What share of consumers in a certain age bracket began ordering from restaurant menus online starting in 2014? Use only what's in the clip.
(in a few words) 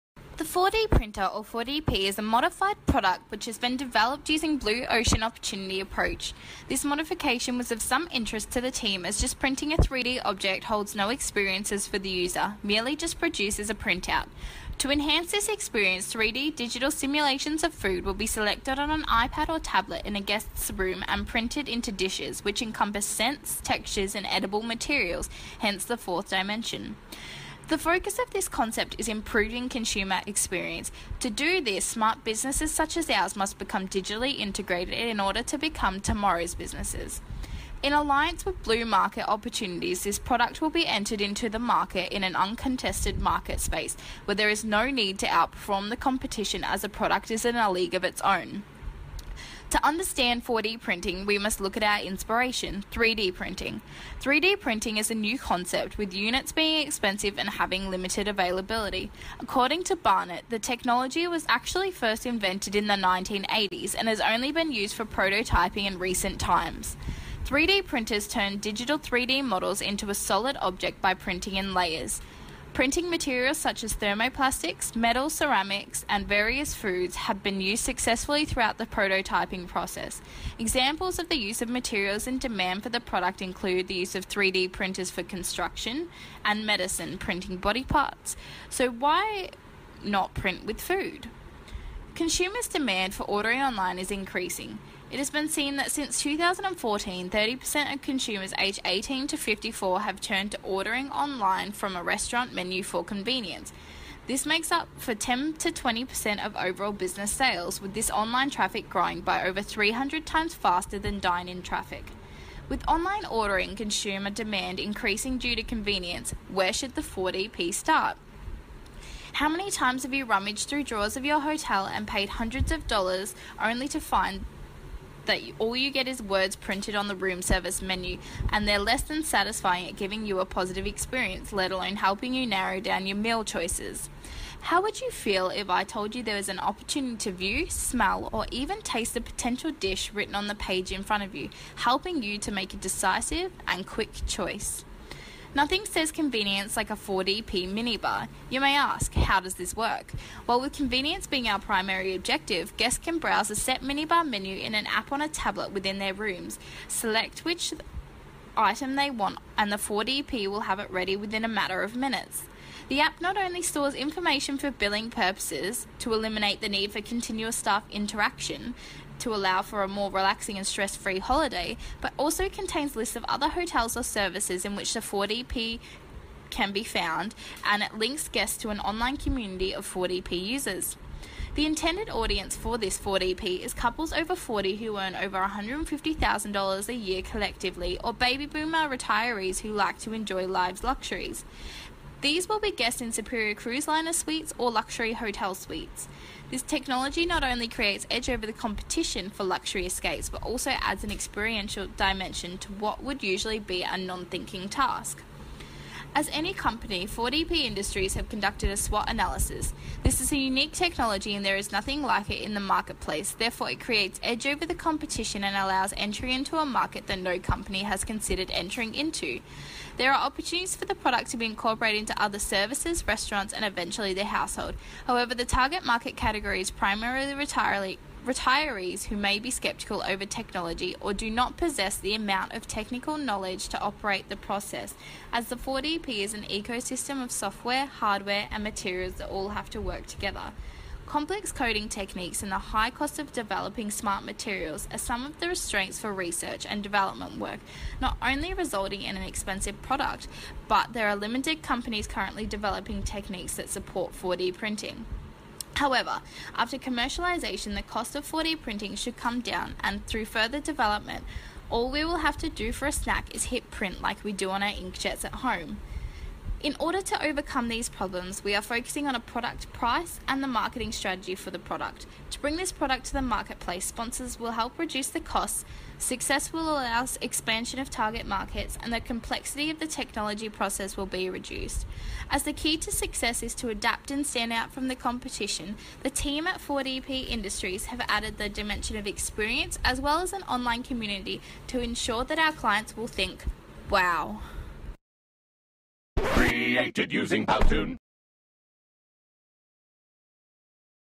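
30%.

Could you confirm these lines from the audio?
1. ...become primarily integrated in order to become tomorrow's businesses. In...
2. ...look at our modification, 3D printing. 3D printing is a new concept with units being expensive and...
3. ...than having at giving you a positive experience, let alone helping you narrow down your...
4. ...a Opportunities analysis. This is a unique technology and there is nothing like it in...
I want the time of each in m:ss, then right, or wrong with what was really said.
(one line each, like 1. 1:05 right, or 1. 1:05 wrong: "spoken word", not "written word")
1. 0:33 wrong: "digitally", not "primarily"
2. 0:51 wrong: "inspiration", not "modification"
3. 2:09 wrong: "satisfying", not "having"
4. 3:28 wrong: "SWOT", not "Opportunities".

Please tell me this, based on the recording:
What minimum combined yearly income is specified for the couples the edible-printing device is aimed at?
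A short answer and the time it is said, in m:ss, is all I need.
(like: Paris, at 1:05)
$150,000, at 3:05.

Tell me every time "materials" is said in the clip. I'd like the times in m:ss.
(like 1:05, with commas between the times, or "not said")
0:24, 1:13, 1:21, 3:58, 4:04.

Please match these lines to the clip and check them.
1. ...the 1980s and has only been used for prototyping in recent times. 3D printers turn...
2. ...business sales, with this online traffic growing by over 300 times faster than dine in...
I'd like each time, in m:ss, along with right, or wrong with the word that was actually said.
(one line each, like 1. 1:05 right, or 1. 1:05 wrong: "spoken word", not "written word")
1. 1:02 right
2. 1:46 right.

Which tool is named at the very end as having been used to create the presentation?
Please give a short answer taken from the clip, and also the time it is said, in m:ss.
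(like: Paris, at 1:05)
Powtoon, at 4:57.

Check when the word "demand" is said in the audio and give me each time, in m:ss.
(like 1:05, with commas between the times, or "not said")
1:22, 1:32, 1:54.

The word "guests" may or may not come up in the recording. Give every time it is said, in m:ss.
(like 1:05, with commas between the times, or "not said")
0:20, 2:32, 2:58, 3:12.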